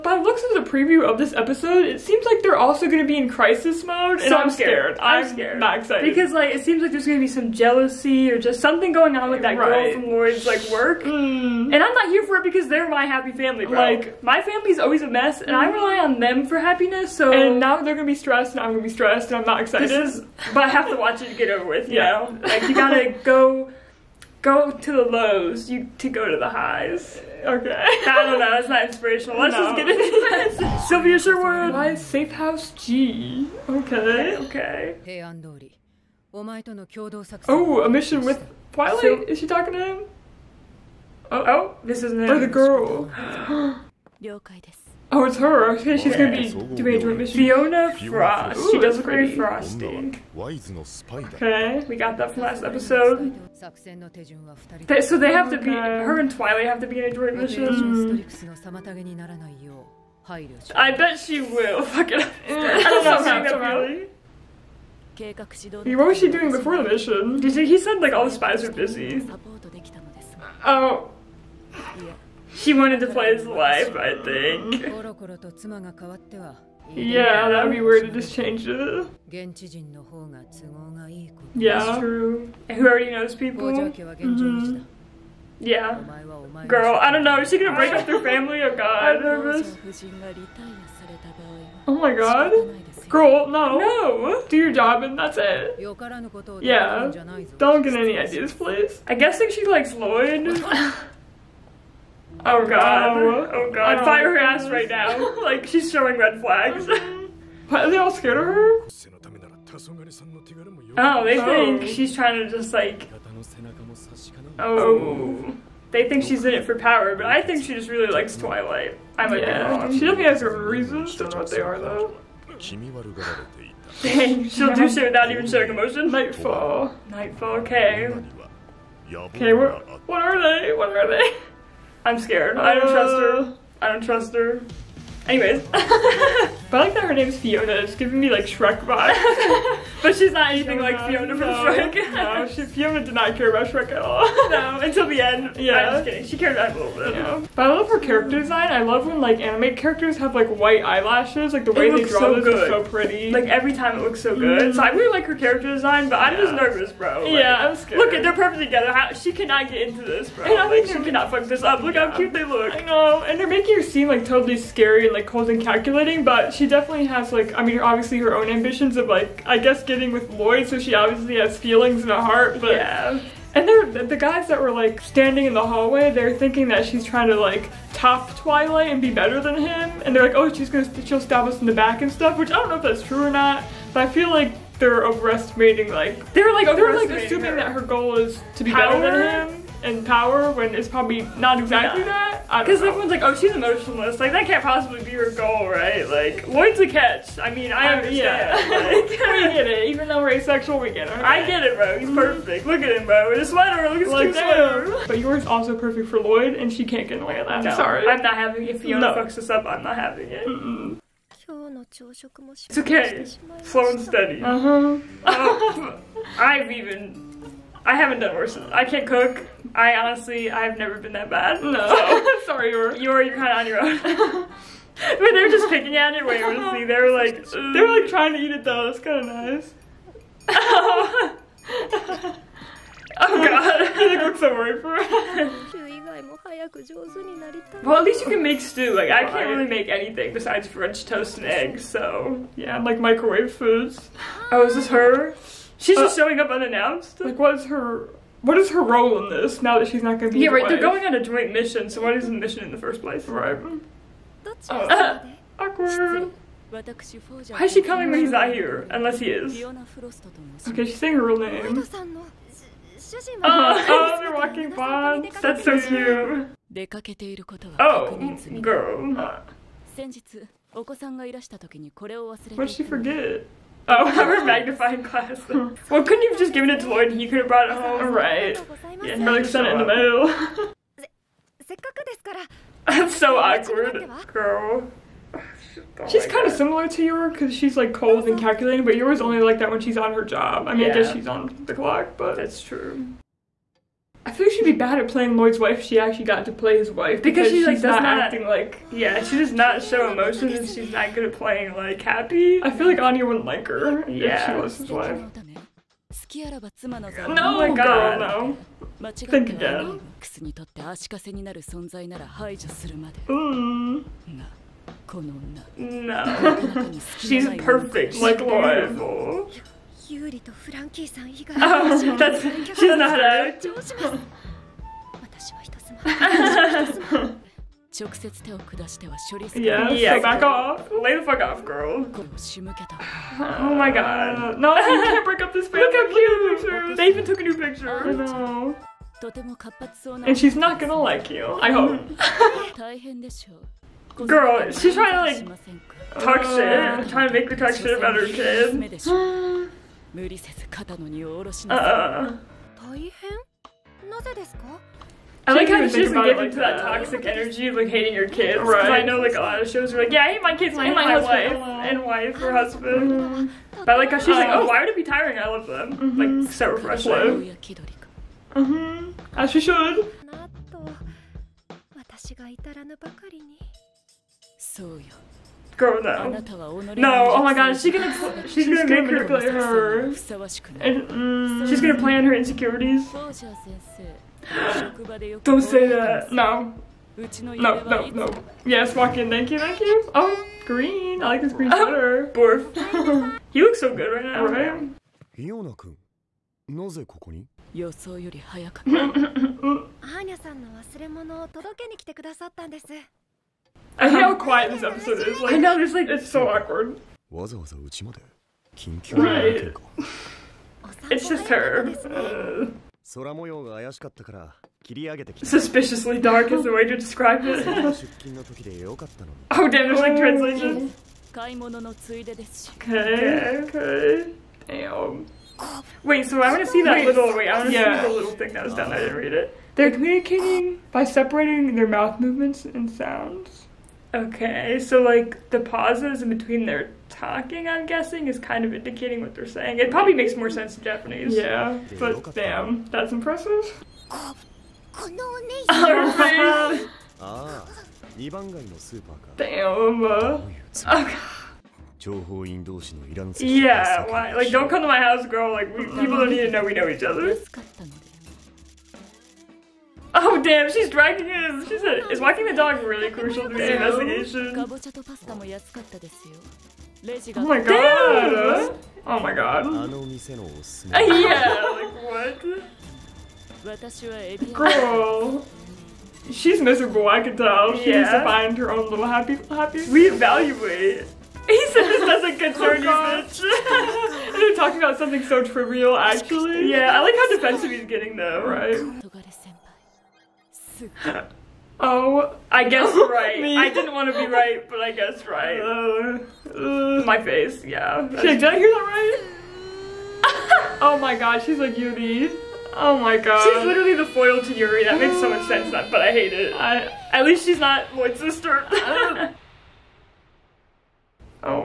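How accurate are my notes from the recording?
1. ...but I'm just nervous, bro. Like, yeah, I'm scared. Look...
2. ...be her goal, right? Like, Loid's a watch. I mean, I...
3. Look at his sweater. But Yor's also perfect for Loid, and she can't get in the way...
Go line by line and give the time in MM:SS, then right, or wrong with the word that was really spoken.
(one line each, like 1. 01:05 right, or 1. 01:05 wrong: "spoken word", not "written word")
1. 02:36 right
2. 03:15 wrong: "catch", not "watch"
3. 03:23 right.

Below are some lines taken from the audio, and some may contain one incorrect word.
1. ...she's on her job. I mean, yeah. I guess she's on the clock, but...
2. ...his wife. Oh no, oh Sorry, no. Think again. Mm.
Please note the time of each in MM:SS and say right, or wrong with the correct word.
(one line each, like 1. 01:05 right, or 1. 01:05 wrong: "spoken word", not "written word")
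1. 04:49 right
2. 05:04 wrong: "God", not "Sorry".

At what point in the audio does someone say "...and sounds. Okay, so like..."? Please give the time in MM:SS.
07:12.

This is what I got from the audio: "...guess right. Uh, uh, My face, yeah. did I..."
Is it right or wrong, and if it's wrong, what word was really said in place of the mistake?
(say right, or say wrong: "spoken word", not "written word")
right.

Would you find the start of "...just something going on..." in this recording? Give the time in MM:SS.
00:08.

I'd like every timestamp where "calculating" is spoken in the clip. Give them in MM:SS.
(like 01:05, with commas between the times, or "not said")
02:45, 04:48.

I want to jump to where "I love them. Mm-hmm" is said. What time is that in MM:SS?
06:05.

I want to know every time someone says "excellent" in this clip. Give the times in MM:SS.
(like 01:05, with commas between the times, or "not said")
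not said.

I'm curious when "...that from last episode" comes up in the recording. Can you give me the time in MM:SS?
00:52.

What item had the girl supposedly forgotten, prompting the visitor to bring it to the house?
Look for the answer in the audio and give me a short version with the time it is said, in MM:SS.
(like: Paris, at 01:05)
magnifying glass, at 04:34.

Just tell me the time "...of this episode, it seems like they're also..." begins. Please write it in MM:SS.
00:01.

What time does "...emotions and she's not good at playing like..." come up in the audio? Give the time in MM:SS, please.
05:00.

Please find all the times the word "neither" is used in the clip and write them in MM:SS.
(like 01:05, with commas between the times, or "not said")
not said.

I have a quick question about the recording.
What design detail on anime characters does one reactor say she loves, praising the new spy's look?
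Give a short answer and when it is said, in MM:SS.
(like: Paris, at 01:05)
white eyelashes, at 02:30.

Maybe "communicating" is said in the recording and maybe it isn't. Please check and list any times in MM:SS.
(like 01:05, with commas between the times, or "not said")
07:09.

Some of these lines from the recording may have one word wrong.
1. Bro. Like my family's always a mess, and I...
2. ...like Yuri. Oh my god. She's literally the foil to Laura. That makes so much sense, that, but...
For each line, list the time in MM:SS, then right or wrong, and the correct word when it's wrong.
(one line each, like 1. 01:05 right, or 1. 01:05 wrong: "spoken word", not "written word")
1. 00:13 right
2. 08:21 wrong: "Yuri", not "Laura".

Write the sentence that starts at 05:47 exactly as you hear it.
trying to make the talk shit about her kid.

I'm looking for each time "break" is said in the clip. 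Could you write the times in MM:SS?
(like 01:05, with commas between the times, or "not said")
01:27, 05:35.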